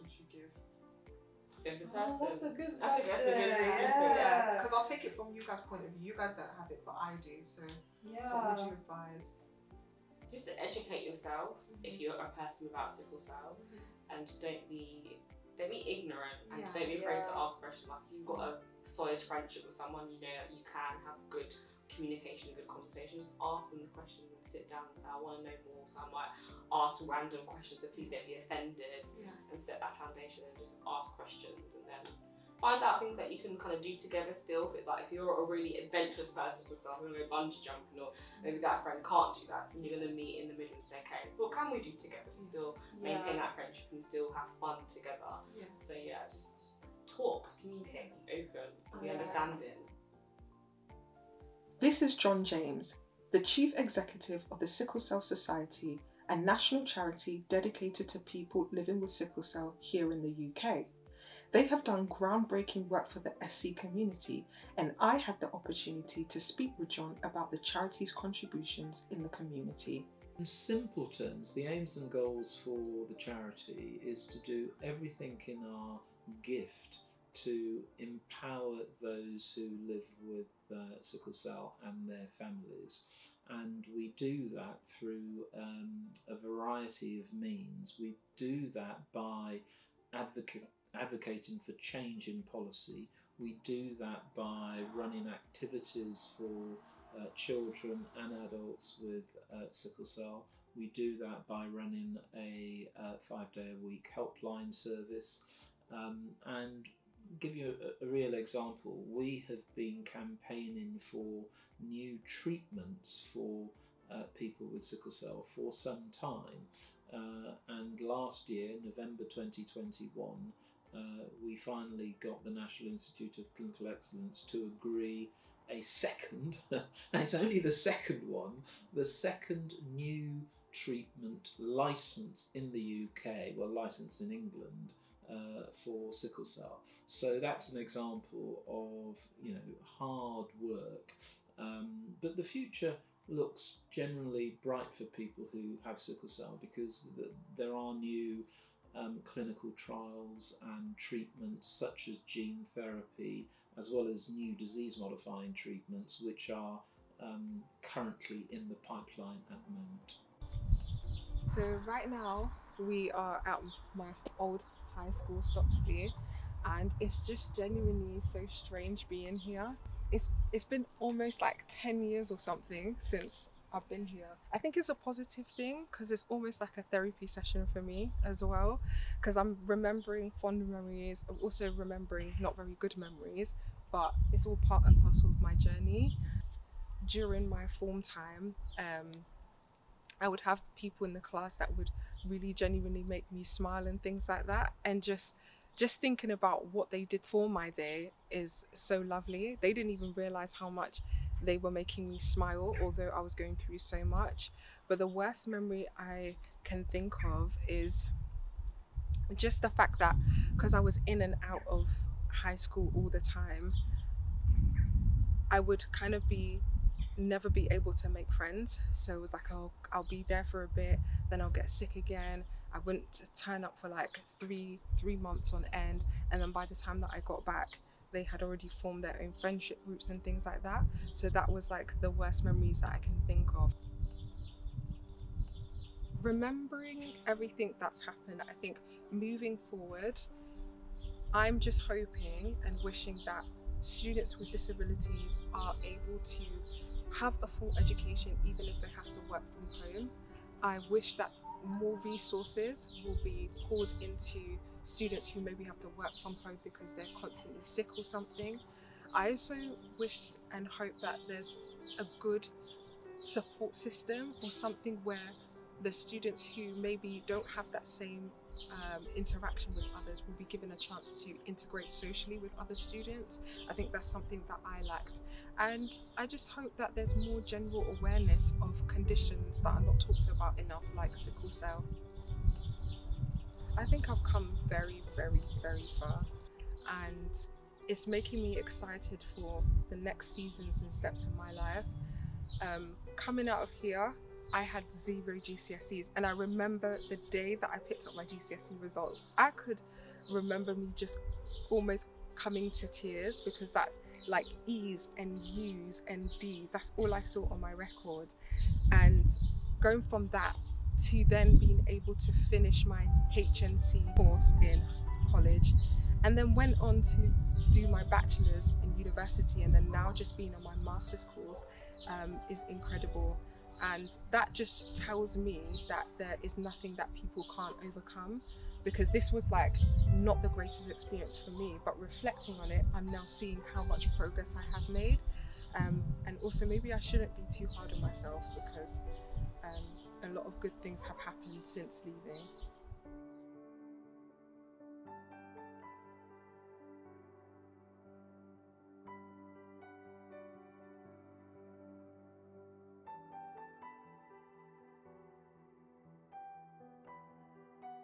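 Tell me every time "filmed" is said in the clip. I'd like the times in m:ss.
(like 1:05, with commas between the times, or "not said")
not said.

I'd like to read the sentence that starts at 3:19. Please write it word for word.
They didn't even realize how much they were making me smile, although I was going through so much.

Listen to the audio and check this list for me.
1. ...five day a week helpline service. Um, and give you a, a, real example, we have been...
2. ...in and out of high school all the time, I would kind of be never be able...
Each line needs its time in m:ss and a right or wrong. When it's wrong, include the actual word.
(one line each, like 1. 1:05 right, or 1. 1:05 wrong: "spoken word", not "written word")
1. 1:43 right
2. 3:31 right.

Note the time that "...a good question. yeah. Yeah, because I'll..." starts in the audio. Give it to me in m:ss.
0:02.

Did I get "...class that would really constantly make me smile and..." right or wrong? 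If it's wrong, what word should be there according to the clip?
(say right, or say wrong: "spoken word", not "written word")
wrong: "genuinely", not "constantly".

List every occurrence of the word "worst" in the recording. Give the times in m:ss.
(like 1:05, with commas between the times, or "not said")
3:25, 3:52.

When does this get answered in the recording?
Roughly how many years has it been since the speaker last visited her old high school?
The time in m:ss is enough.
2:51.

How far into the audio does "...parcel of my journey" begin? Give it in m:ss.
3:05.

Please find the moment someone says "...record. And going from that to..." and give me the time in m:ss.
5:07.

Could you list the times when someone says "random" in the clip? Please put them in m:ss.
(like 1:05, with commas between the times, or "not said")
0:27.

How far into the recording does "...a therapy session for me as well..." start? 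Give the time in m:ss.
2:56.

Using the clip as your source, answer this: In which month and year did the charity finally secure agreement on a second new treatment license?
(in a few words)
November 2021.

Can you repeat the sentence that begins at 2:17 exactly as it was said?
So that's an example of you know hard work.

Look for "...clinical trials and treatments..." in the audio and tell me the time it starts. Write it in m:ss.
2:29.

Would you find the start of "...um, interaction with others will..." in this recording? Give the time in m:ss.
4:28.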